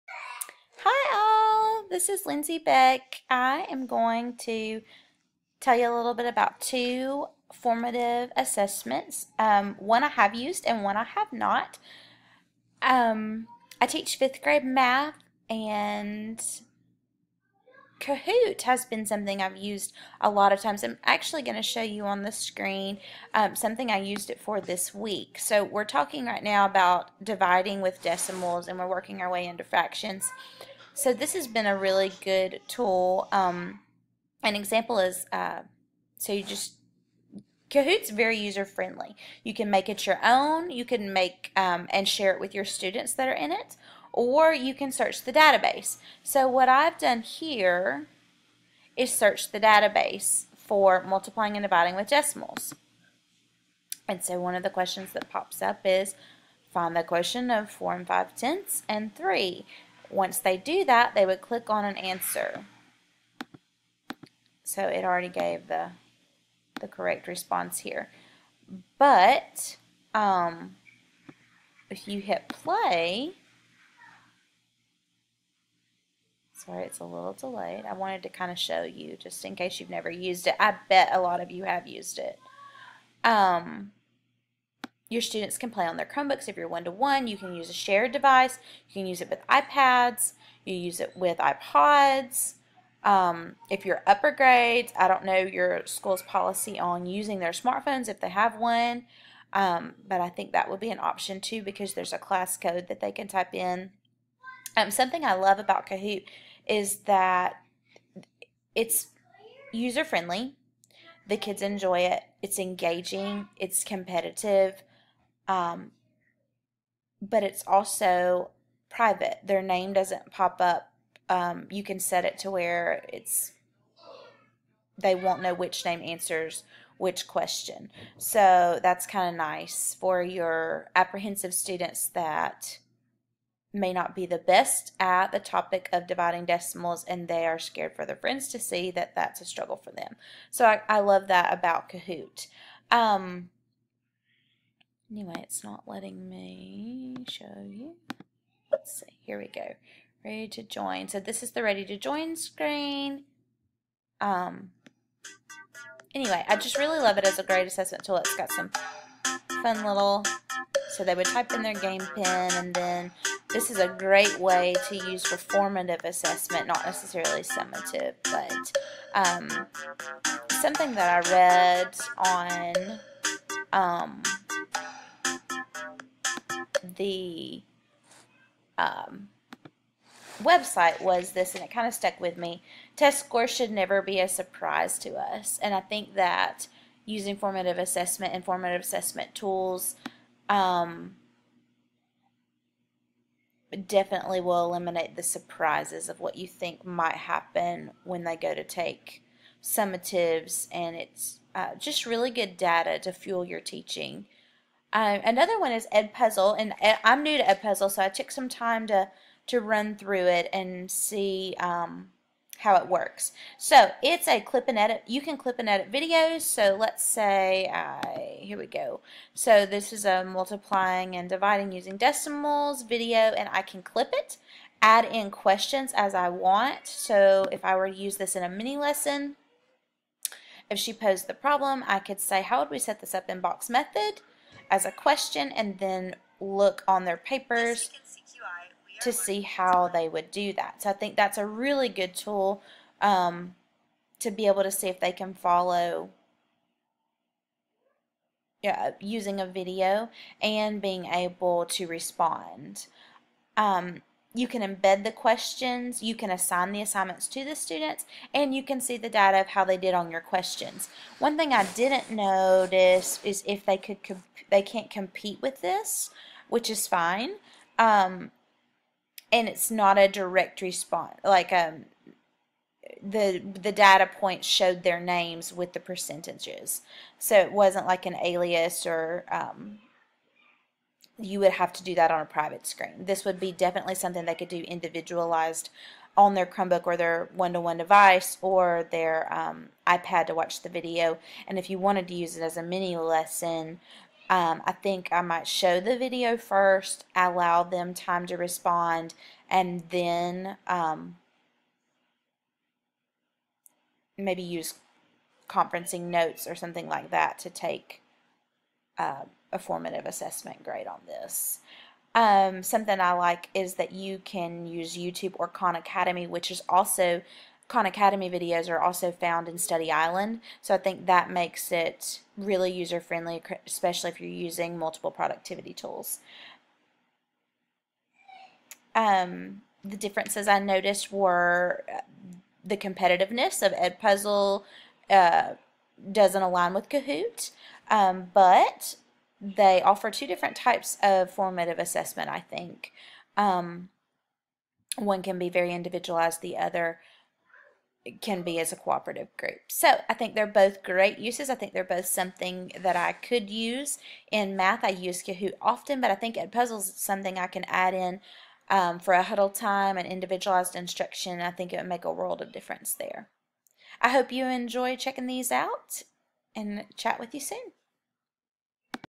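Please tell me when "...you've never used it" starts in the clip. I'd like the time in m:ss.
1:19.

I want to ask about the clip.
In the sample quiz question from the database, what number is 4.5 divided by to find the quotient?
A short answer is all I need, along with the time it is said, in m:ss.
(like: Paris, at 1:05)
3, at 0:59.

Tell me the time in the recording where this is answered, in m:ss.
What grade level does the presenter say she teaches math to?
0:14.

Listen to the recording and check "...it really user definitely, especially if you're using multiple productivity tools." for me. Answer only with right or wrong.
wrong.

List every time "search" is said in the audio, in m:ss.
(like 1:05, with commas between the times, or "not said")
0:44, 0:49.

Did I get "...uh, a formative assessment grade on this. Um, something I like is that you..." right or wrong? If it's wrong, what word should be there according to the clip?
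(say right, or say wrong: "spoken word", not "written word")
right.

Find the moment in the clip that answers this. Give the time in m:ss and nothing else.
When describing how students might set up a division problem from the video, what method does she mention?
3:53.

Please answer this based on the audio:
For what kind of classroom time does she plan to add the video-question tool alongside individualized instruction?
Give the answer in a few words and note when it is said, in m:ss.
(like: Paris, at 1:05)
Huddle time, at 5:59.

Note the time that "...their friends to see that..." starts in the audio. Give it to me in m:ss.
2:18.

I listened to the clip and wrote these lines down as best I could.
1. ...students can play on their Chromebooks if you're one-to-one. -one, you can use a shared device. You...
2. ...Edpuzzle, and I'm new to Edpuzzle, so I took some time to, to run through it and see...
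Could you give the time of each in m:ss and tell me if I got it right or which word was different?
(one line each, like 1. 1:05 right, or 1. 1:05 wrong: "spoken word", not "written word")
1. 1:25 right
2. 3:25 right.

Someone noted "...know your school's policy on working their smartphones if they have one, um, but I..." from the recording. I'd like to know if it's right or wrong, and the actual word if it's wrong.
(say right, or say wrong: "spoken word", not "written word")
wrong: "using", not "working".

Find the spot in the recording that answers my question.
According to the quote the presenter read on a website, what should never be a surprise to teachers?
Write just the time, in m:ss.
3:02.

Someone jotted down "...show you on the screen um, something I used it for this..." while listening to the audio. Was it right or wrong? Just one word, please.
right.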